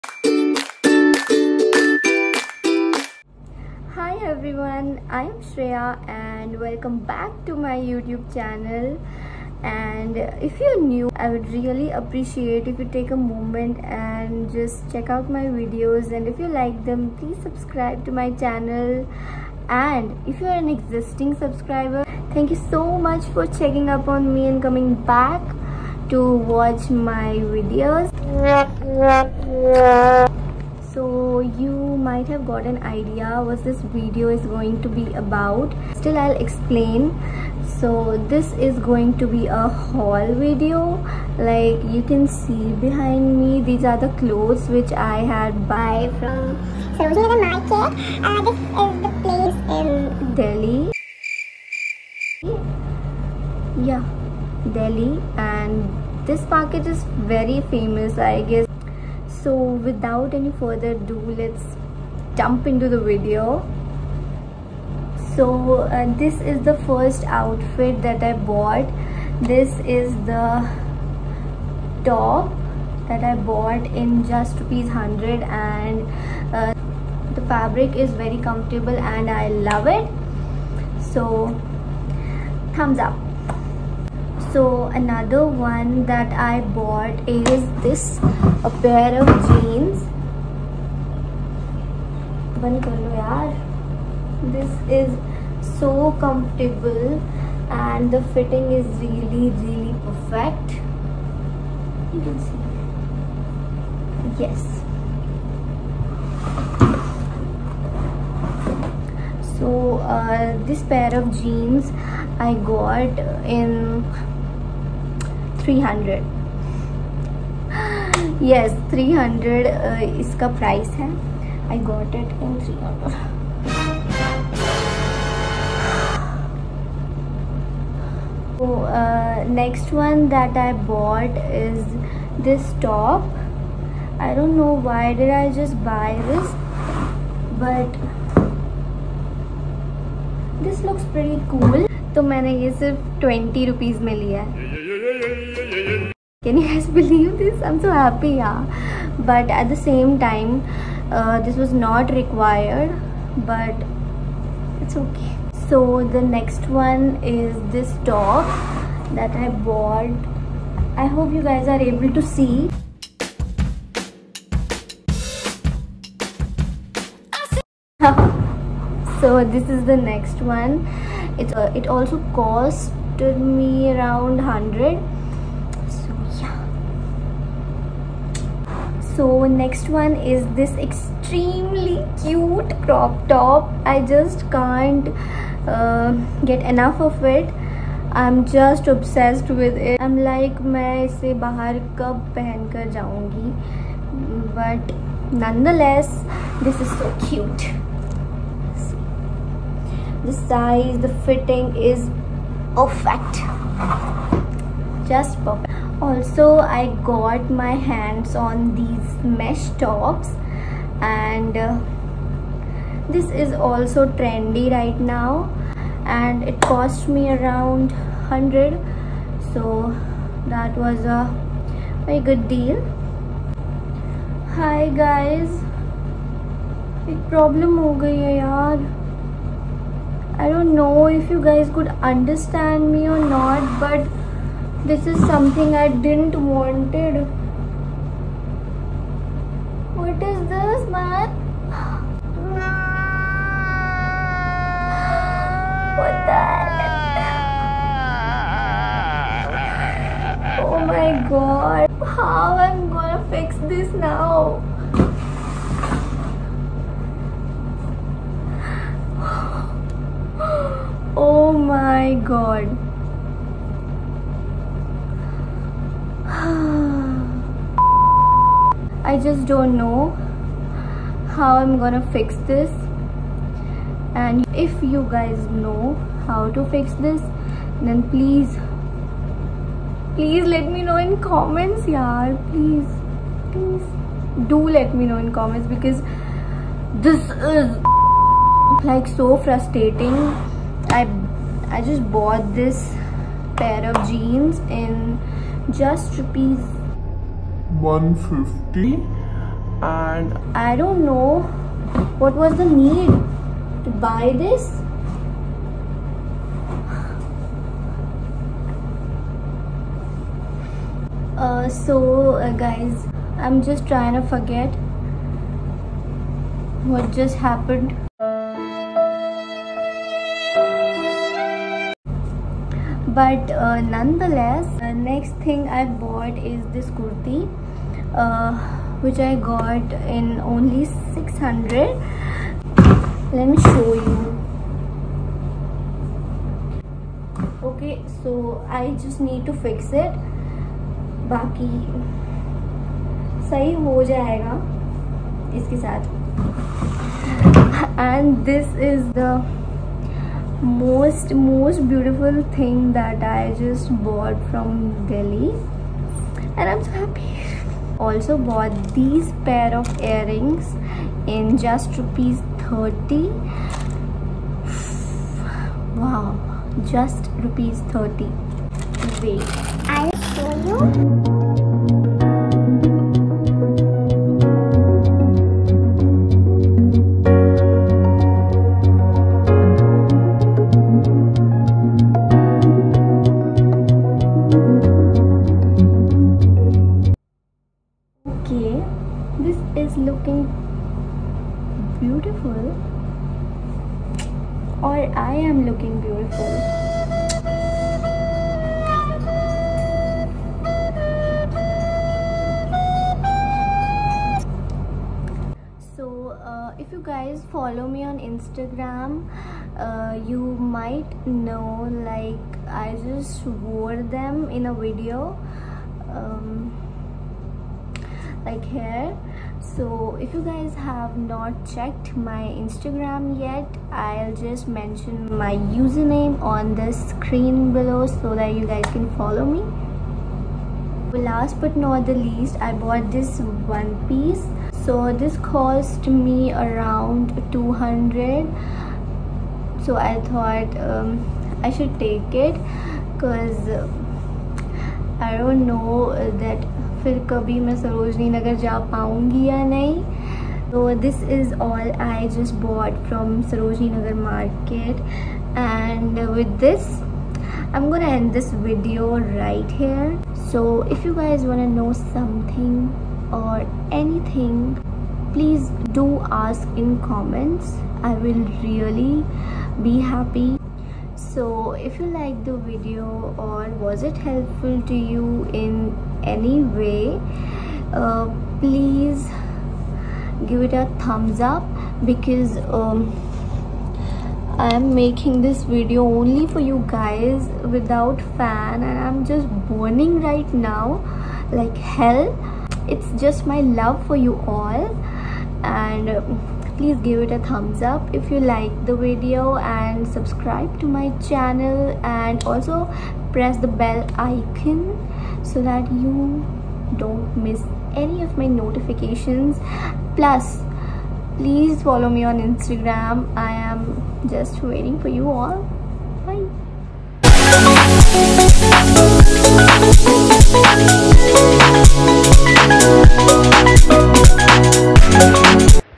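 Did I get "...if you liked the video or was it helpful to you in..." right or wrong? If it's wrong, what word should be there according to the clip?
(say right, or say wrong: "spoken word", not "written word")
right.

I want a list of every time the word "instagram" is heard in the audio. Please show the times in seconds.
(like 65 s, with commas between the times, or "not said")
408 s, 422 s, 512 s.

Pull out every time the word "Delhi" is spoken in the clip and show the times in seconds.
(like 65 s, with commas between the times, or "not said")
50 s, 54 s, 355 s.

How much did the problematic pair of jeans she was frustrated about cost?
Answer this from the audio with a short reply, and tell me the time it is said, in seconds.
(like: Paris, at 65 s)
150 rupees, at 296 s.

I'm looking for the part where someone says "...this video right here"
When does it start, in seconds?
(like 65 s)
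458 s.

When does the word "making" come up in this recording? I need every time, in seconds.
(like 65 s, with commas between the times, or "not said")
484 s.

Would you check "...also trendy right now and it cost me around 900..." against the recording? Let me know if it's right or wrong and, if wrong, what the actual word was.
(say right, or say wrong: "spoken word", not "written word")
wrong: "100", not "900".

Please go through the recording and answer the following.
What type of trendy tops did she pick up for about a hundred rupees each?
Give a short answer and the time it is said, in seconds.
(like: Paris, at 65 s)
mesh tops, at 209 s.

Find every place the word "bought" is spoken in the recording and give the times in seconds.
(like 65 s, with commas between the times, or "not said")
68 s, 73 s, 86 s, 159 s, 292 s, 354 s, 358 s, 432 s.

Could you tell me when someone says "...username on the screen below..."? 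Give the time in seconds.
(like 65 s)
425 s.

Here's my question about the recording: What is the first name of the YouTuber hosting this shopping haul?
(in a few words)
Shriya.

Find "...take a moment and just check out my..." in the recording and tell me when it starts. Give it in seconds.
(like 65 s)
12 s.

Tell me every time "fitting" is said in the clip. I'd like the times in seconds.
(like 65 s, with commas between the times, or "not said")
98 s, 201 s.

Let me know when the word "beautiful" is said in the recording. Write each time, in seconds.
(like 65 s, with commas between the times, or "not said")
351 s, 396 s.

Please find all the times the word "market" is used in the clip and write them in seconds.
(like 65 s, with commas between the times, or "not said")
47 s, 56 s.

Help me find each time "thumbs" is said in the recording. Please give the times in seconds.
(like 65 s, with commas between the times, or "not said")
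82 s, 480 s, 497 s.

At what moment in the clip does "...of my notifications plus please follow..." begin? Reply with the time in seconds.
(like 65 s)
508 s.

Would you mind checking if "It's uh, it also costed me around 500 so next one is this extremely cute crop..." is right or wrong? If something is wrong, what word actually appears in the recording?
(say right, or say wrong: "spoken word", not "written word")
wrong: "100", not "500".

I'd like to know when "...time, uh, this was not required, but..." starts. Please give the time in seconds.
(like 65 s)
150 s.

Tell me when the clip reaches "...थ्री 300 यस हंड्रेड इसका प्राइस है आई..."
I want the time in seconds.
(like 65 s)
115 s.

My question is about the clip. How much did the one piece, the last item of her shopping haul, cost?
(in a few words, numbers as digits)
200 rupees.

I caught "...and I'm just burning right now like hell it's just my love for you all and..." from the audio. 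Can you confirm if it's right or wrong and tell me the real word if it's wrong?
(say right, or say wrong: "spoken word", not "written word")
right.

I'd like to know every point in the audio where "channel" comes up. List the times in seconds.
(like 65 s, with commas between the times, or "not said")
8 s, 18 s, 501 s.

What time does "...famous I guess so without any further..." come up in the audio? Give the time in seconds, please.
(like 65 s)
57 s.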